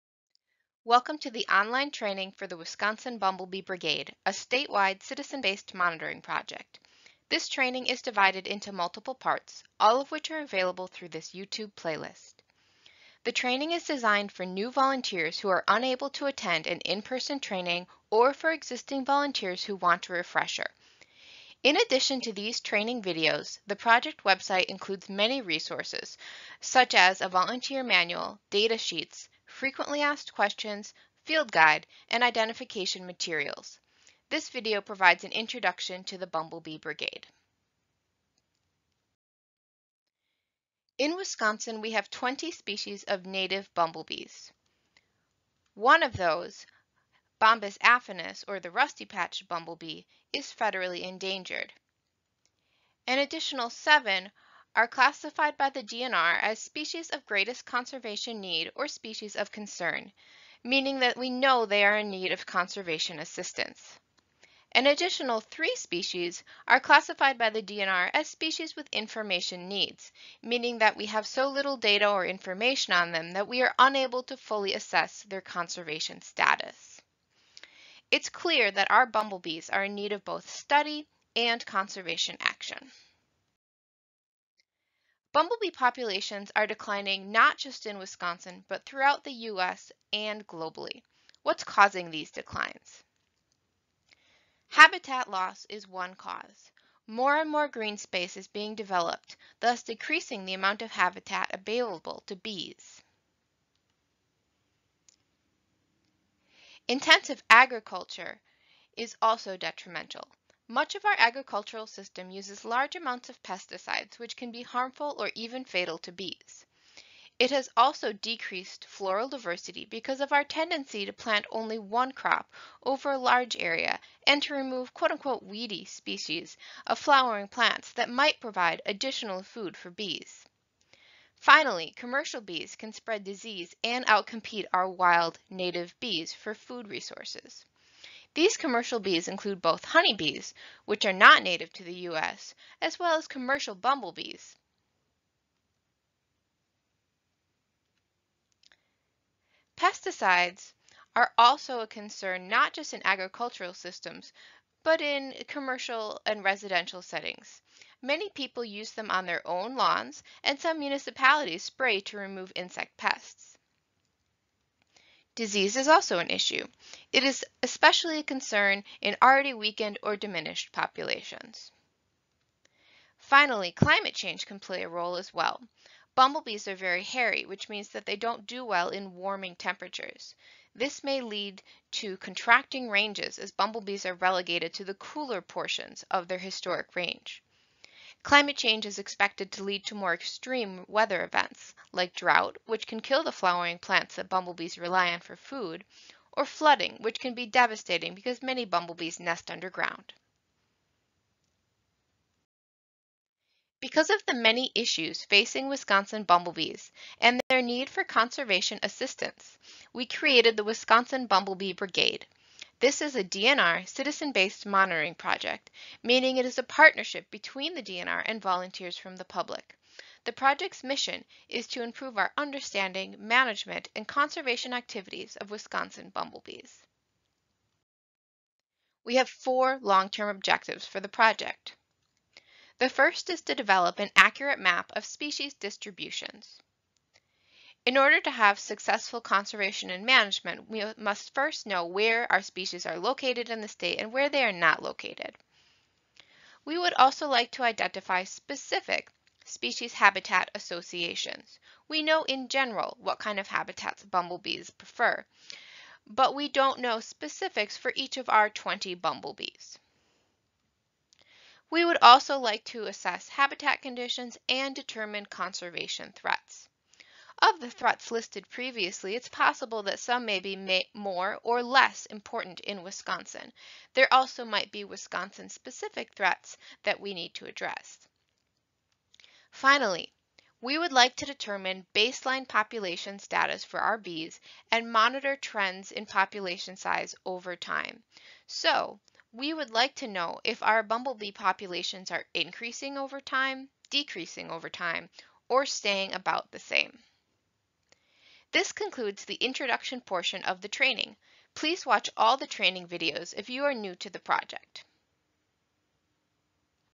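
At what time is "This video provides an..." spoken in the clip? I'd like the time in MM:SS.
00:34.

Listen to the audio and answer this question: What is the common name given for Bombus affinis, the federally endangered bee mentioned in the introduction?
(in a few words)
rusty Patch bumblebee.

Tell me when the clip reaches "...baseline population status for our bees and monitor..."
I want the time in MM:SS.
04:41.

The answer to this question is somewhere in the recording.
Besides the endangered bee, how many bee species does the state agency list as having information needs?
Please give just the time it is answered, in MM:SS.
01:05.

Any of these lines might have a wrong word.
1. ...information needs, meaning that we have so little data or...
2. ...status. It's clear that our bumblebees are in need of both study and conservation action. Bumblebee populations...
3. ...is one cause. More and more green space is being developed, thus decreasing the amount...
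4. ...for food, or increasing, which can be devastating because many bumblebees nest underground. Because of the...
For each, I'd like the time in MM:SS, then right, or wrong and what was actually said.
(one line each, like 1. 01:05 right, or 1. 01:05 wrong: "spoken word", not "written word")
1. 01:08 right
2. 01:16 right
3. 01:35 right
4. 03:15 wrong: "flooding", not "increasing".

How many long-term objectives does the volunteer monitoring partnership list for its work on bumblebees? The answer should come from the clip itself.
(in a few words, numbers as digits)
4.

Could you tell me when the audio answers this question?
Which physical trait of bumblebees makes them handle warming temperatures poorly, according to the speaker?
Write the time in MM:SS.
02:56.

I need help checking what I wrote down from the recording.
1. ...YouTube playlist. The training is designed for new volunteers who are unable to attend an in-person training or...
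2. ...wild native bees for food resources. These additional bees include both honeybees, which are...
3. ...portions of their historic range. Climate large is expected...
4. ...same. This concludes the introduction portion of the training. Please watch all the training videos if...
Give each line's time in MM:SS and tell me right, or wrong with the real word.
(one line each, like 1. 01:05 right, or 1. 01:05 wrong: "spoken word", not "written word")
1. 00:11 right
2. 02:14 wrong: "commercial", not "additional"
3. 03:05 wrong: "change", not "large"
4. 04:56 right.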